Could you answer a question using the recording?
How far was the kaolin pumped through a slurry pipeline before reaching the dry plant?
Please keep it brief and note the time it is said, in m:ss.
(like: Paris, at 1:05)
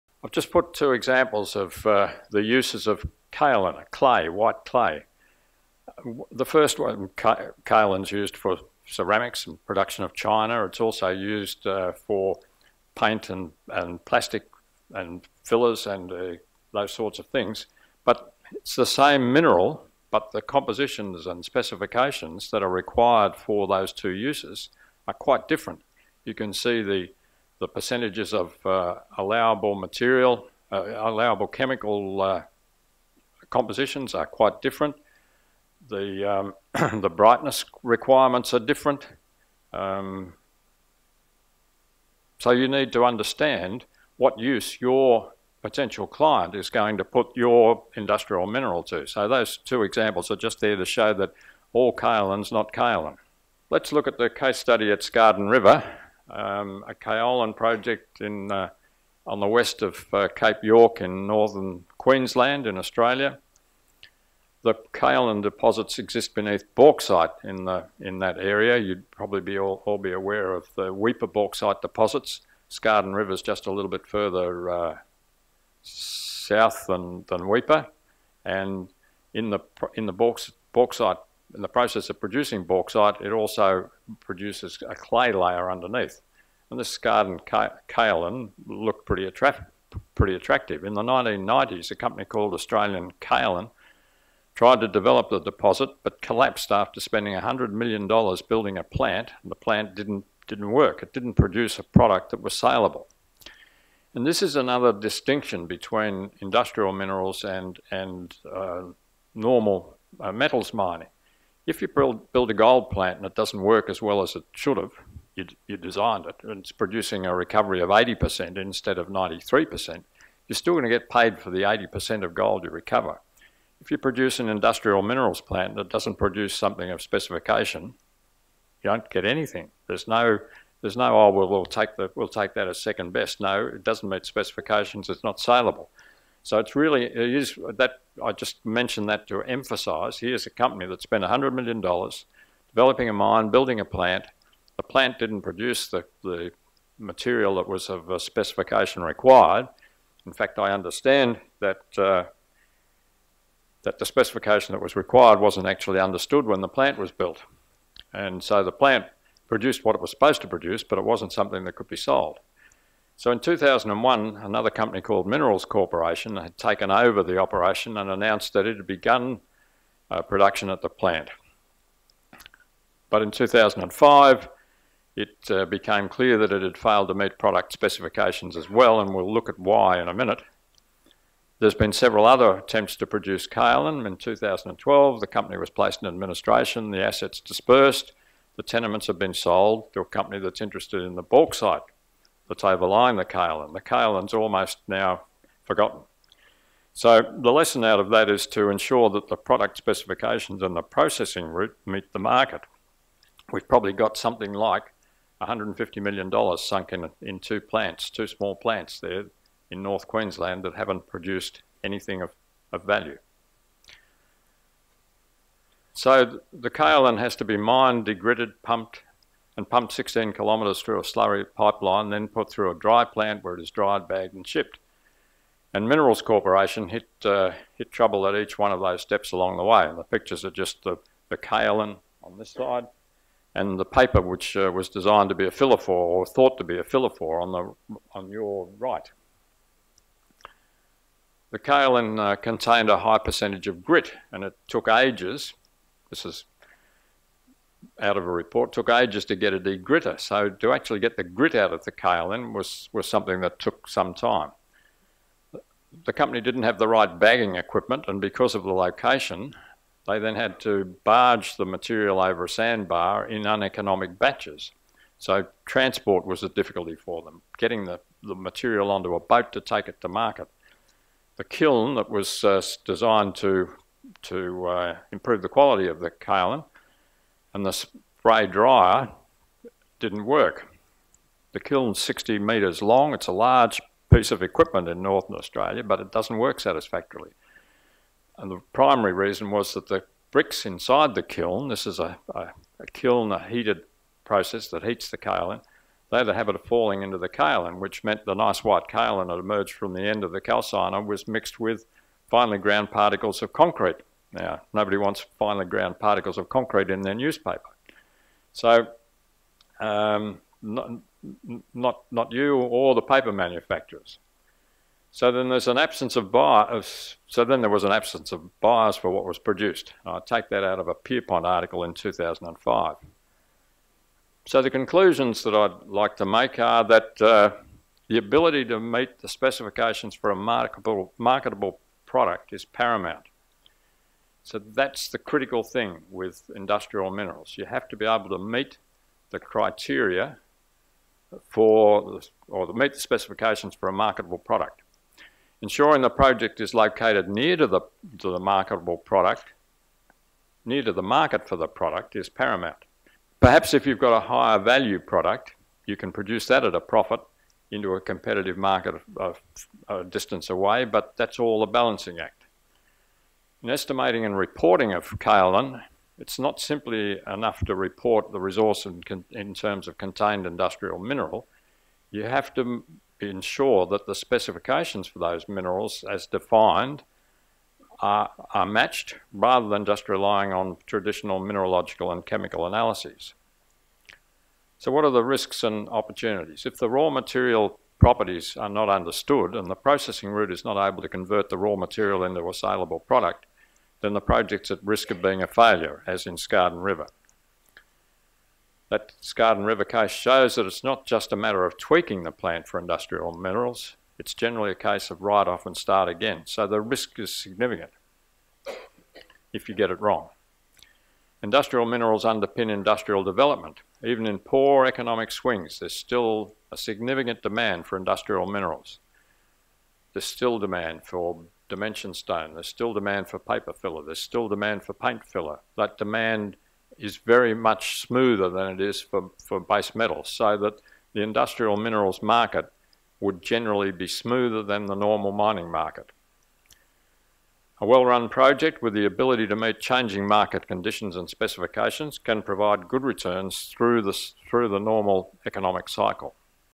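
16 kilometres, at 3:39.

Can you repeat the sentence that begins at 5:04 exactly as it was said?
Now, nobody wants finely ground particles of concrete in their newspaper.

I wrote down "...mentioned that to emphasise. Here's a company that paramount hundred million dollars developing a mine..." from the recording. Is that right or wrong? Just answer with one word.
wrong.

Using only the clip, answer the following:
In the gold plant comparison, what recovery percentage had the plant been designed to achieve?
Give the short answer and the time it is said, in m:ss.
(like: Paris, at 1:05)
93%, at 1:59.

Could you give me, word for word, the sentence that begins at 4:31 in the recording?
The kiln that was uh, designed to, to uh, improve the quality of the kaolin and the spray dryer didn't work.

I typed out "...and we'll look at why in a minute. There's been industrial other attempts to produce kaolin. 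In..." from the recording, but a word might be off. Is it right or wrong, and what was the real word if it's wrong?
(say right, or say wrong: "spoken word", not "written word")
wrong: "several", not "industrial".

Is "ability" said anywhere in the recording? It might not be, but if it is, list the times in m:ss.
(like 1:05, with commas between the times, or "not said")
5:28, 7:19.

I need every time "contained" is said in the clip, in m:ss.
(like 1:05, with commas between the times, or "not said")
4:02, 6:09.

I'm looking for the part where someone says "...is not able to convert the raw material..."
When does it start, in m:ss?
6:30.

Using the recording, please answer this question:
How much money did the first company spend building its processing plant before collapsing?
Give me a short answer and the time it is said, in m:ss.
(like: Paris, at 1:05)
$100 million, at 1:37.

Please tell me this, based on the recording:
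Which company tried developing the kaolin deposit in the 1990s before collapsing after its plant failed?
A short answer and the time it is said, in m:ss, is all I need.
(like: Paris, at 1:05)
Australian Kaolin, at 1:32.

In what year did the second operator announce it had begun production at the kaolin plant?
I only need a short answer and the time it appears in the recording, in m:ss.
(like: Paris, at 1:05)
2001, at 2:43.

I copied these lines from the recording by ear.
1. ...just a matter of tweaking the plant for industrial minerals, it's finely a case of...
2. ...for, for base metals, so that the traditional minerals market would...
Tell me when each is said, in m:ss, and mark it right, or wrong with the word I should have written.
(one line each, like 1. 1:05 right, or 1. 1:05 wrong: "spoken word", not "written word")
1. 6:41 wrong: "generally", not "finely"
2. 7:09 wrong: "industrial", not "traditional".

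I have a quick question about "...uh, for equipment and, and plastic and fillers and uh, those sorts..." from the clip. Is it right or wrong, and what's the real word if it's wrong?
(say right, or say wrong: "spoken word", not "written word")
wrong: "paint", not "equipment".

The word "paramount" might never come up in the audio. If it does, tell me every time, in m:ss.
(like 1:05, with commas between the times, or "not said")
5:32, 5:52.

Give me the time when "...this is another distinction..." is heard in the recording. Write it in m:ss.
1:44.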